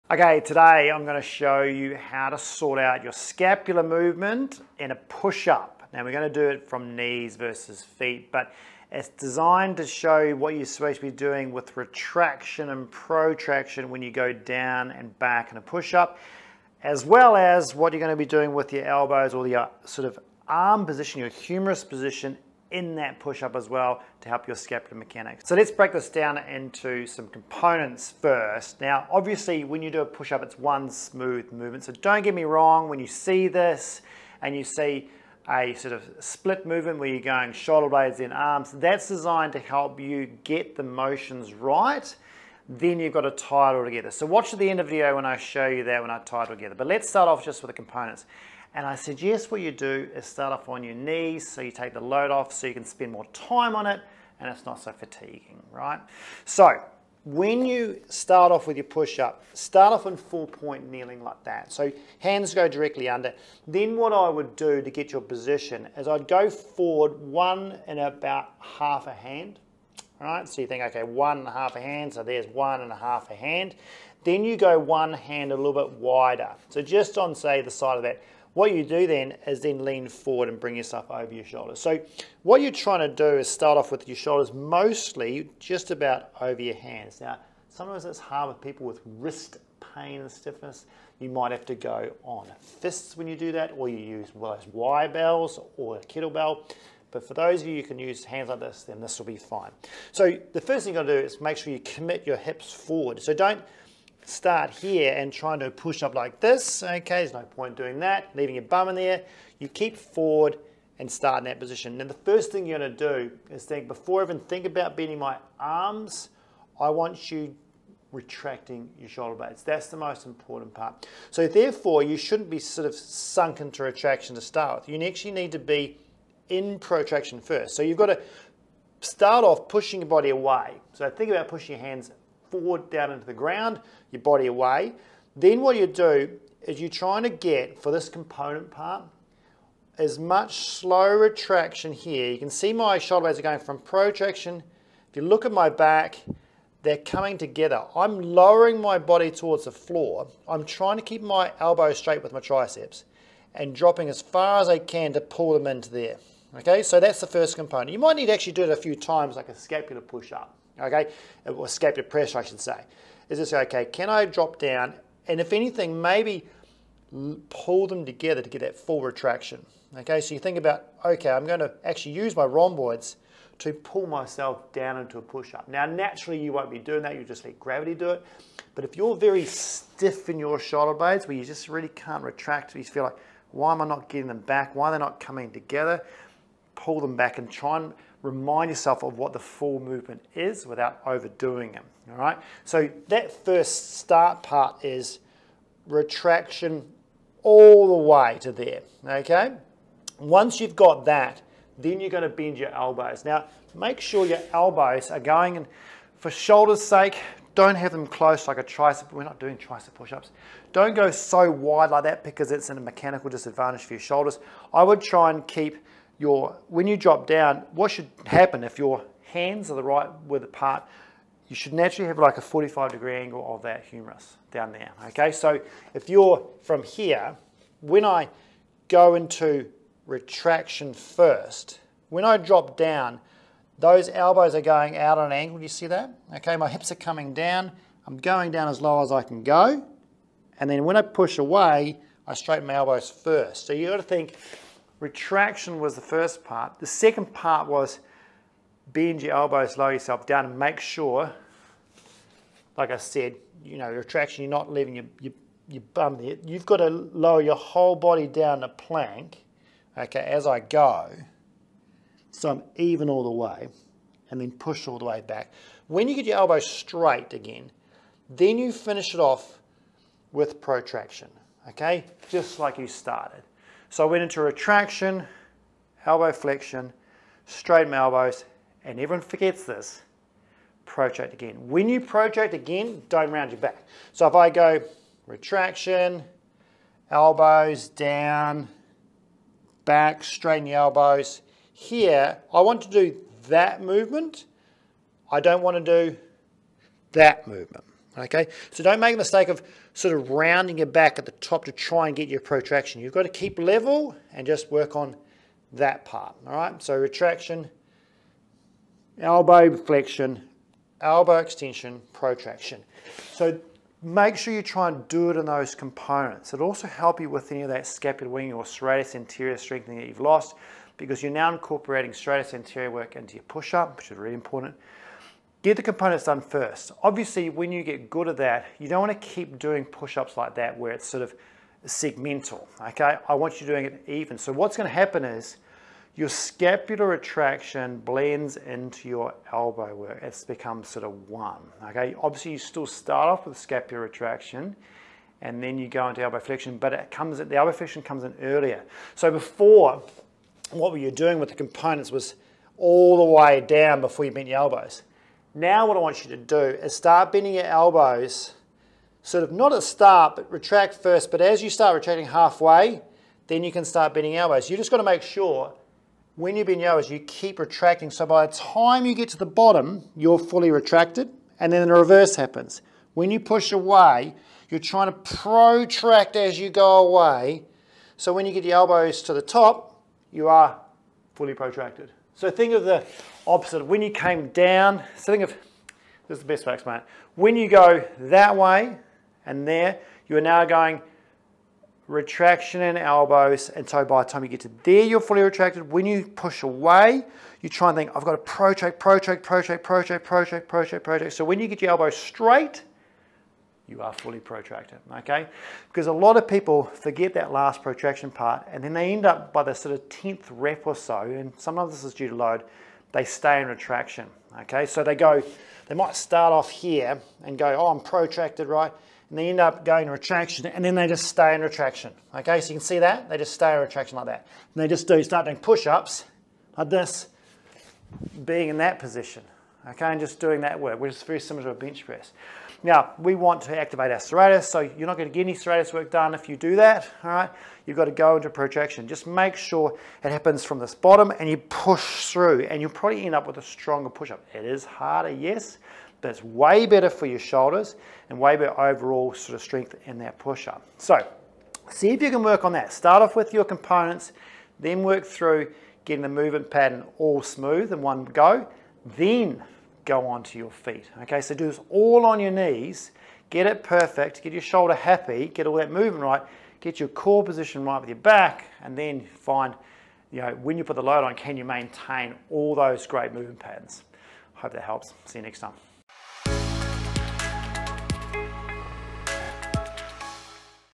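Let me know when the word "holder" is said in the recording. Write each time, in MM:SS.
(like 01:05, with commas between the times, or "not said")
not said.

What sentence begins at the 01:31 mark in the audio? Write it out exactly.
You might have to go on fists when you do that, or you use well, those Y bells or a kettlebell.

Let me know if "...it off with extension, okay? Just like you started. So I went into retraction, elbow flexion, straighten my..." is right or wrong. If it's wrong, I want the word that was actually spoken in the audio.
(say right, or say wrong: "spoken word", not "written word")
wrong: "protraction", not "extension".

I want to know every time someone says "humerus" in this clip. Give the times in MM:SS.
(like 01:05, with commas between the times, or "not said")
00:21, 03:43.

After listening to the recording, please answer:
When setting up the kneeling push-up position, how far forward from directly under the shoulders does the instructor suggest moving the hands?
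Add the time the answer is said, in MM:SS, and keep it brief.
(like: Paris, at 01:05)
1 and a half hands, at 01:07.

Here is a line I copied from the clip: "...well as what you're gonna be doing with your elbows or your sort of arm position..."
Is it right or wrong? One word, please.
right.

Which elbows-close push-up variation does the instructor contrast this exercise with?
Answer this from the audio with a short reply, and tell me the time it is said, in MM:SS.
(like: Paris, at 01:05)
Tricep push-ups, at 03:29.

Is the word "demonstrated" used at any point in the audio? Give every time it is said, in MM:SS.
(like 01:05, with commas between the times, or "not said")
not said.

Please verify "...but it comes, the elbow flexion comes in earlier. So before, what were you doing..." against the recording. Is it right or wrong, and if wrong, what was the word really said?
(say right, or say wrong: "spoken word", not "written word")
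right.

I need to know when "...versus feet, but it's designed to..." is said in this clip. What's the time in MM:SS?
00:07.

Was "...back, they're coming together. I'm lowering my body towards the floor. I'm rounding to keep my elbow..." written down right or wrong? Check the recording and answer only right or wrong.
wrong.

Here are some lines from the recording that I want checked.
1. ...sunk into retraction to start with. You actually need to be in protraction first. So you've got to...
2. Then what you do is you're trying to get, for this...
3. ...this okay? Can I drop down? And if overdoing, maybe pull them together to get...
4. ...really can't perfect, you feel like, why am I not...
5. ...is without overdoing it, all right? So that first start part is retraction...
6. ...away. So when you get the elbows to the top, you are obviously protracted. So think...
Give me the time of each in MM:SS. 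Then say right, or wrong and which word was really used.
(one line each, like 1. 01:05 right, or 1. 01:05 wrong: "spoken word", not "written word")
1. 02:02 right
2. 02:15 right
3. 02:43 wrong: "anything", not "overdoing"
4. 03:01 wrong: "retract", not "perfect"
5. 03:10 right
6. 06:17 wrong: "fully", not "obviously".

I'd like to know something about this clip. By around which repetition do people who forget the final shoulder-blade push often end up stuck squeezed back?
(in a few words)
10th.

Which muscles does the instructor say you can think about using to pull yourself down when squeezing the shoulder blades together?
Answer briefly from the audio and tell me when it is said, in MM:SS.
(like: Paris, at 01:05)
Rhomboids, at 02:52.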